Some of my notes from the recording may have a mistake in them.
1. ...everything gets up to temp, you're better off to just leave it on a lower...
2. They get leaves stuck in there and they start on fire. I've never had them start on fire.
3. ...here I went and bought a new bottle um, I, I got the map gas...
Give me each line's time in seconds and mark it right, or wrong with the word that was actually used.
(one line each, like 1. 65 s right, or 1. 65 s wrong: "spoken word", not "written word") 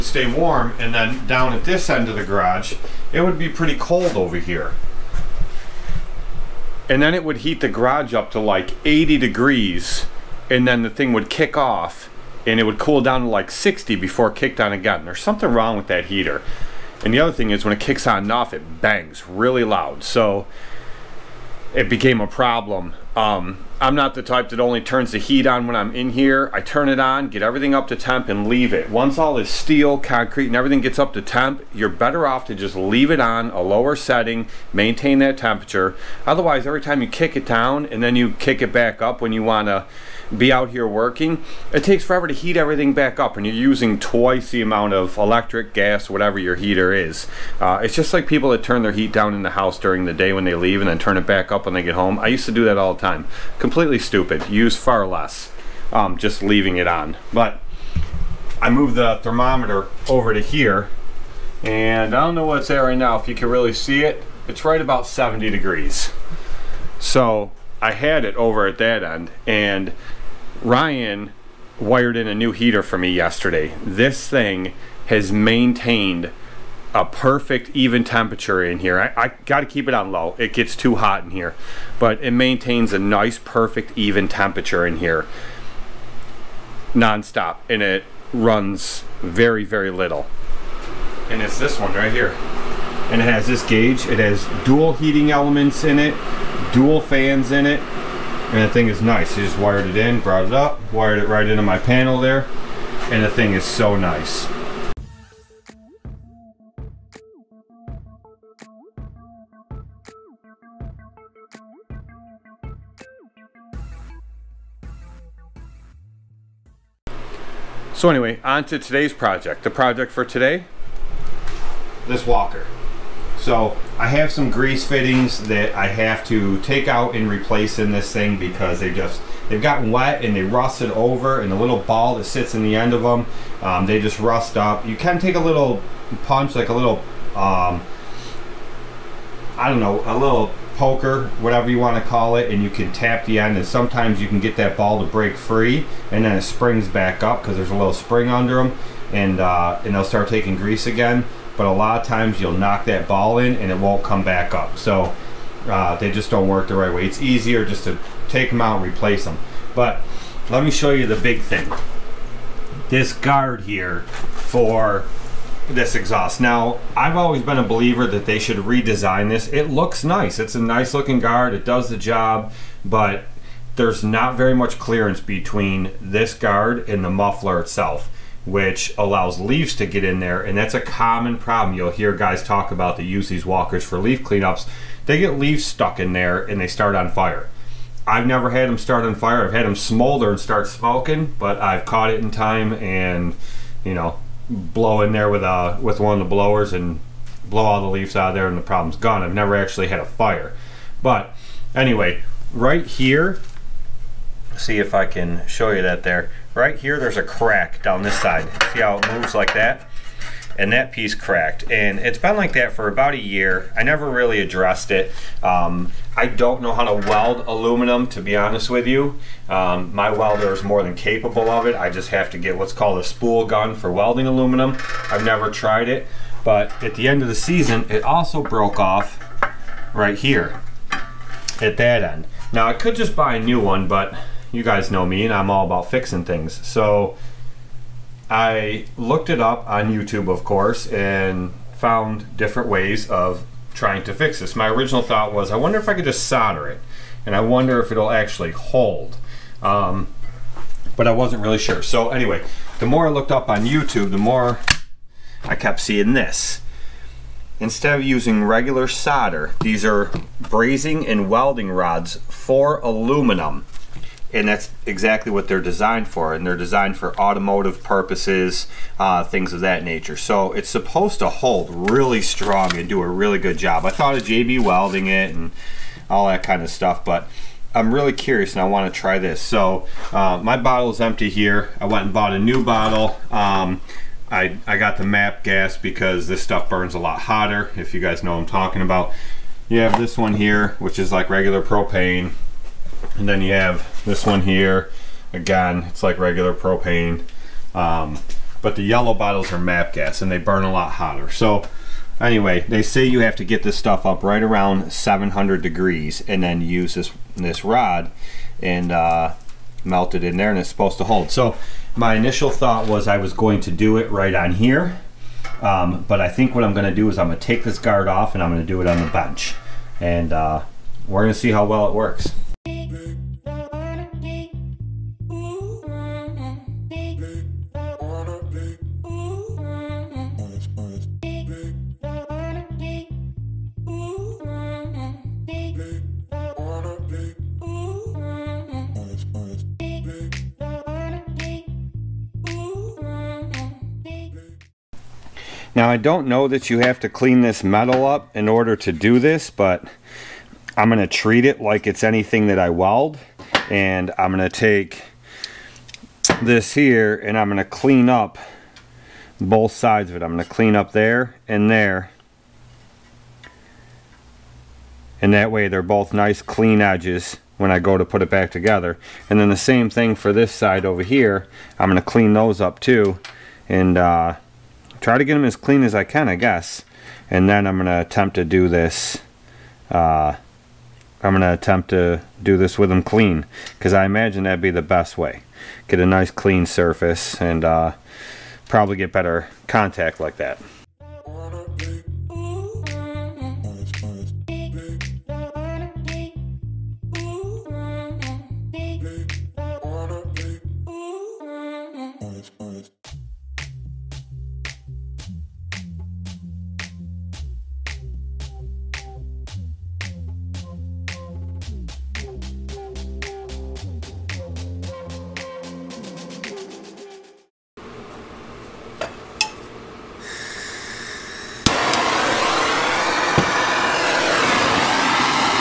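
1. 30 s right
2. 185 s right
3. 281 s right.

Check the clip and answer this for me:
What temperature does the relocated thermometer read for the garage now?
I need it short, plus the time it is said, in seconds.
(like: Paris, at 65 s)
70 degrees, at 65 s.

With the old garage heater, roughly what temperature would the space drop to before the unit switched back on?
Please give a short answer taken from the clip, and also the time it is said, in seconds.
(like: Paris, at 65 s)
60, at 13 s.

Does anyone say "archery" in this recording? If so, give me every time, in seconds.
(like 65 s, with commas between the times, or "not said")
not said.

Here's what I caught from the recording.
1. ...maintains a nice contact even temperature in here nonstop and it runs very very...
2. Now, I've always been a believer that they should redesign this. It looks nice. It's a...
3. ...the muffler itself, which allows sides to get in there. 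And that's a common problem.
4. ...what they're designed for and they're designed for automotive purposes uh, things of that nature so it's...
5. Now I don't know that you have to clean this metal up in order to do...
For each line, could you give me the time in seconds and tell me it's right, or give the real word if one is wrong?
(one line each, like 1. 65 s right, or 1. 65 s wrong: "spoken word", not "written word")
1. 82 s wrong: "perfect", not "contact"
2. 166 s right
3. 177 s wrong: "leaves", not "sides"
4. 265 s right
5. 345 s right.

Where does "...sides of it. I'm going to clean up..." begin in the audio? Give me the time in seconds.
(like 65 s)
359 s.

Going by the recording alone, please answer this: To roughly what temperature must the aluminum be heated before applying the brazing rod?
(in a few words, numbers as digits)
700 degrees.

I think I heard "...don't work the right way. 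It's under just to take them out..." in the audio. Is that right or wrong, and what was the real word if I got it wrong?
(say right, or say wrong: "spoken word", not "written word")
wrong: "easier", not "under".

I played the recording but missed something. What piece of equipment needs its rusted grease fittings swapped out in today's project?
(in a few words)
walker.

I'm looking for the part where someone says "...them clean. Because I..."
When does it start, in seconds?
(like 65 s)
382 s.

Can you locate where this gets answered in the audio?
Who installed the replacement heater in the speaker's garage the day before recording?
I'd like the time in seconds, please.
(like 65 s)
70 s.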